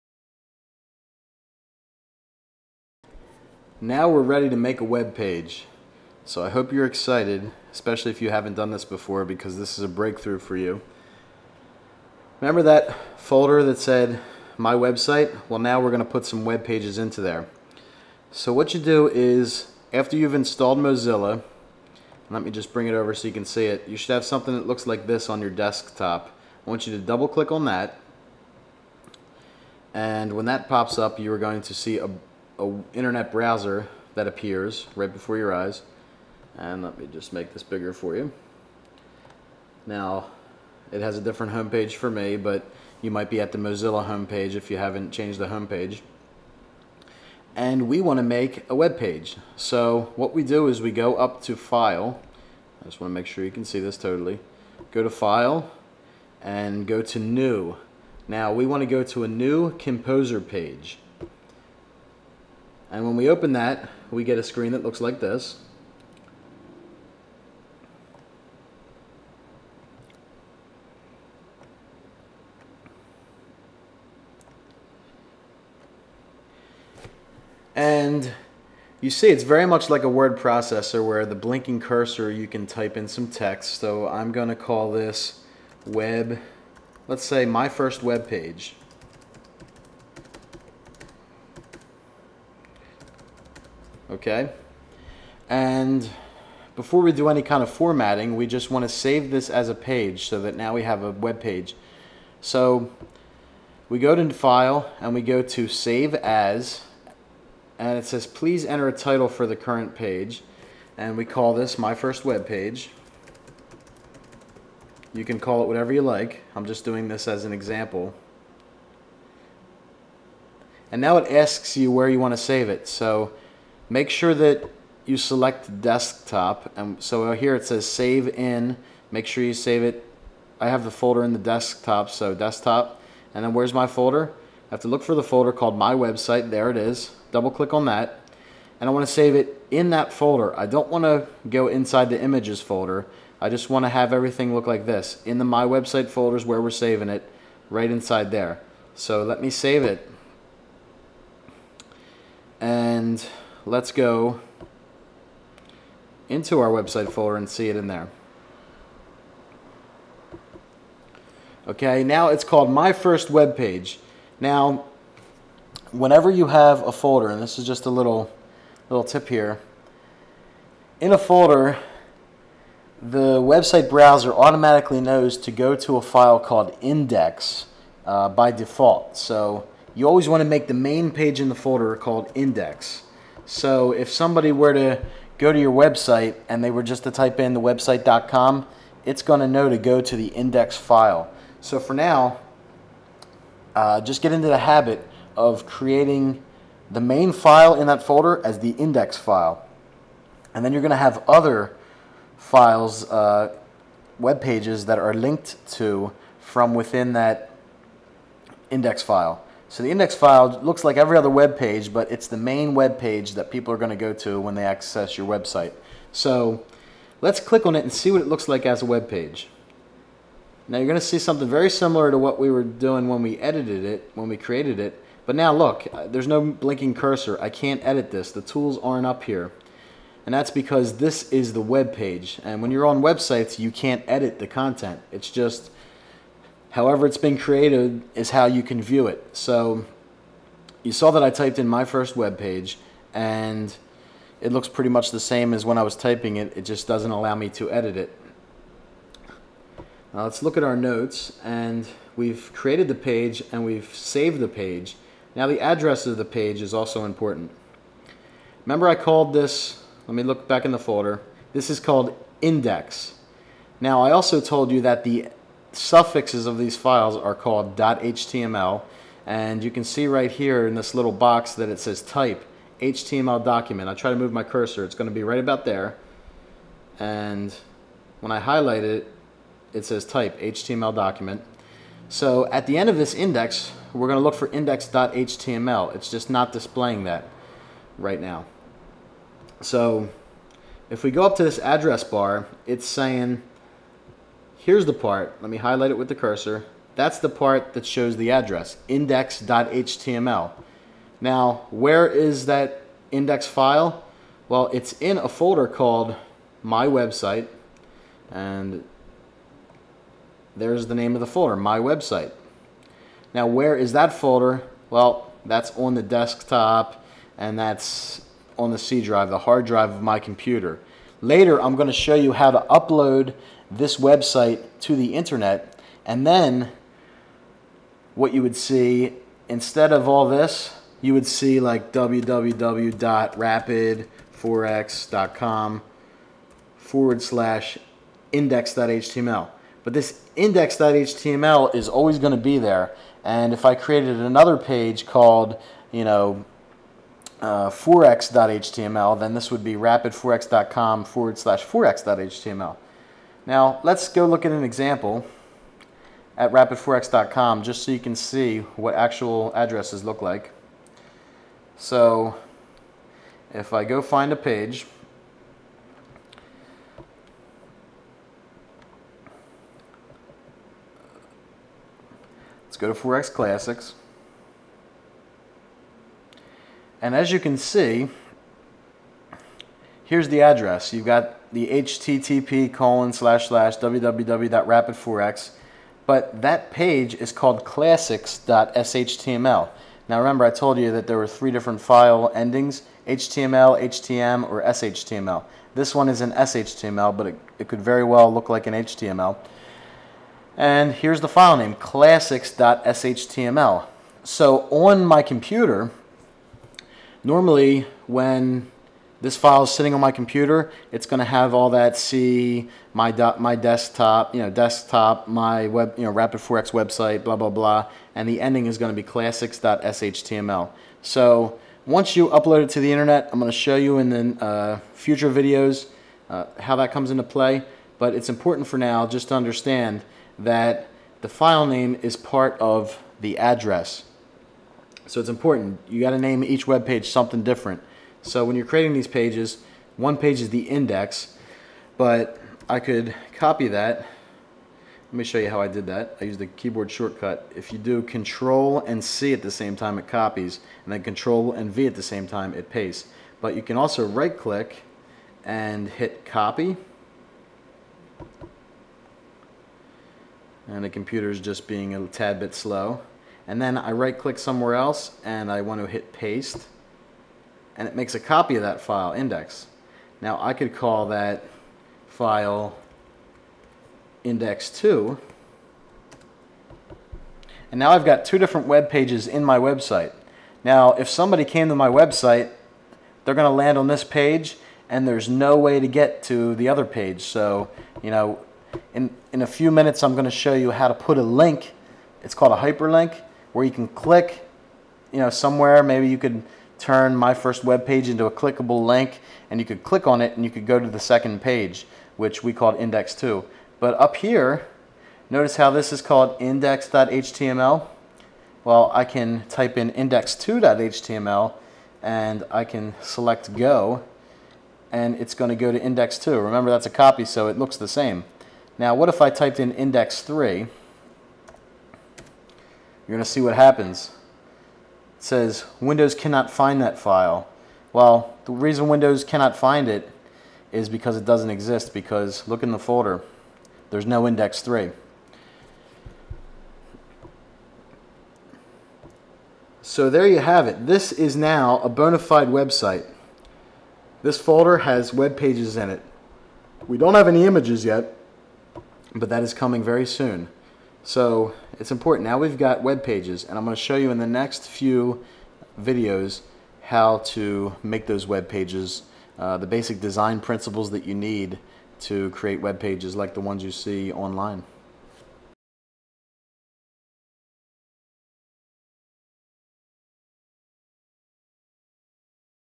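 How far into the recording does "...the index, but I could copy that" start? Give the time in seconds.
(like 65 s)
440 s.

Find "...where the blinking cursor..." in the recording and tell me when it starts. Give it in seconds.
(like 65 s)
81 s.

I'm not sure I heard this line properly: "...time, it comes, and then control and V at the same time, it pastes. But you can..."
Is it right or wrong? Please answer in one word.
wrong.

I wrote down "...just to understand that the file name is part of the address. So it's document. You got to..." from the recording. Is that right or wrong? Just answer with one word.
wrong.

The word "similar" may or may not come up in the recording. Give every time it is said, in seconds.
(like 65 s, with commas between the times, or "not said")
221 s.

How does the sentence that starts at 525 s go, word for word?
It says Windows cannot find that file.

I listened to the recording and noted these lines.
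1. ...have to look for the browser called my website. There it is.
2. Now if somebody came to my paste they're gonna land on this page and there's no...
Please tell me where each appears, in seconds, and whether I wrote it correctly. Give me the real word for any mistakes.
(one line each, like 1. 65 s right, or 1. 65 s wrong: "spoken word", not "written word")
1. 134 s wrong: "folder", not "browser"
2. 480 s wrong: "website", not "paste".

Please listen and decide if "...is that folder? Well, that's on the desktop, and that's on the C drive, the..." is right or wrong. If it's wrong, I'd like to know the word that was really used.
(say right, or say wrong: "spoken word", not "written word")
right.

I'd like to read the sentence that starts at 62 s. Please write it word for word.
And when we open that, we get a screen that looks like this.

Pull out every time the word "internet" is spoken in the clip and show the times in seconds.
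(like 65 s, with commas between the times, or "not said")
32 s, 325 s, 422 s.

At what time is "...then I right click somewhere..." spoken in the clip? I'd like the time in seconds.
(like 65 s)
463 s.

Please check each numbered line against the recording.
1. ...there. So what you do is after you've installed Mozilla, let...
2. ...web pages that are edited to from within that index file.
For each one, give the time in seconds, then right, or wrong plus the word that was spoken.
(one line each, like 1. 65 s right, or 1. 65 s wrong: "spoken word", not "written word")
1. 17 s right
2. 204 s wrong: "linked", not "edited".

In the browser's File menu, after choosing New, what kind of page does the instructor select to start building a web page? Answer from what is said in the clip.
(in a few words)
Composer page.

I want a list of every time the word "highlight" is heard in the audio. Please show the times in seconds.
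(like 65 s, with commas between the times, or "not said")
278 s, 295 s.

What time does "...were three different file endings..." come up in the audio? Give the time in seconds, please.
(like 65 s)
391 s.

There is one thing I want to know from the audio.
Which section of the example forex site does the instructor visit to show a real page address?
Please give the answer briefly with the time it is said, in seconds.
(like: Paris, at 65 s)
Forex Classics, at 372 s.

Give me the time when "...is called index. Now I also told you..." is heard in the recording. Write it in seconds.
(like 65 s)
261 s.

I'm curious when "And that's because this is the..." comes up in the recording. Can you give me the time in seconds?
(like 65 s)
230 s.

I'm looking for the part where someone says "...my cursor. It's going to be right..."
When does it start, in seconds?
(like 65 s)
274 s.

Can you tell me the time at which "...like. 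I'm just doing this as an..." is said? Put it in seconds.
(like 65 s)
116 s.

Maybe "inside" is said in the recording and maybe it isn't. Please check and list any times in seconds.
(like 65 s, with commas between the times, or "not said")
141 s, 147 s.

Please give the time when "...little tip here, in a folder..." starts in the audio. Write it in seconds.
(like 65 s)
168 s.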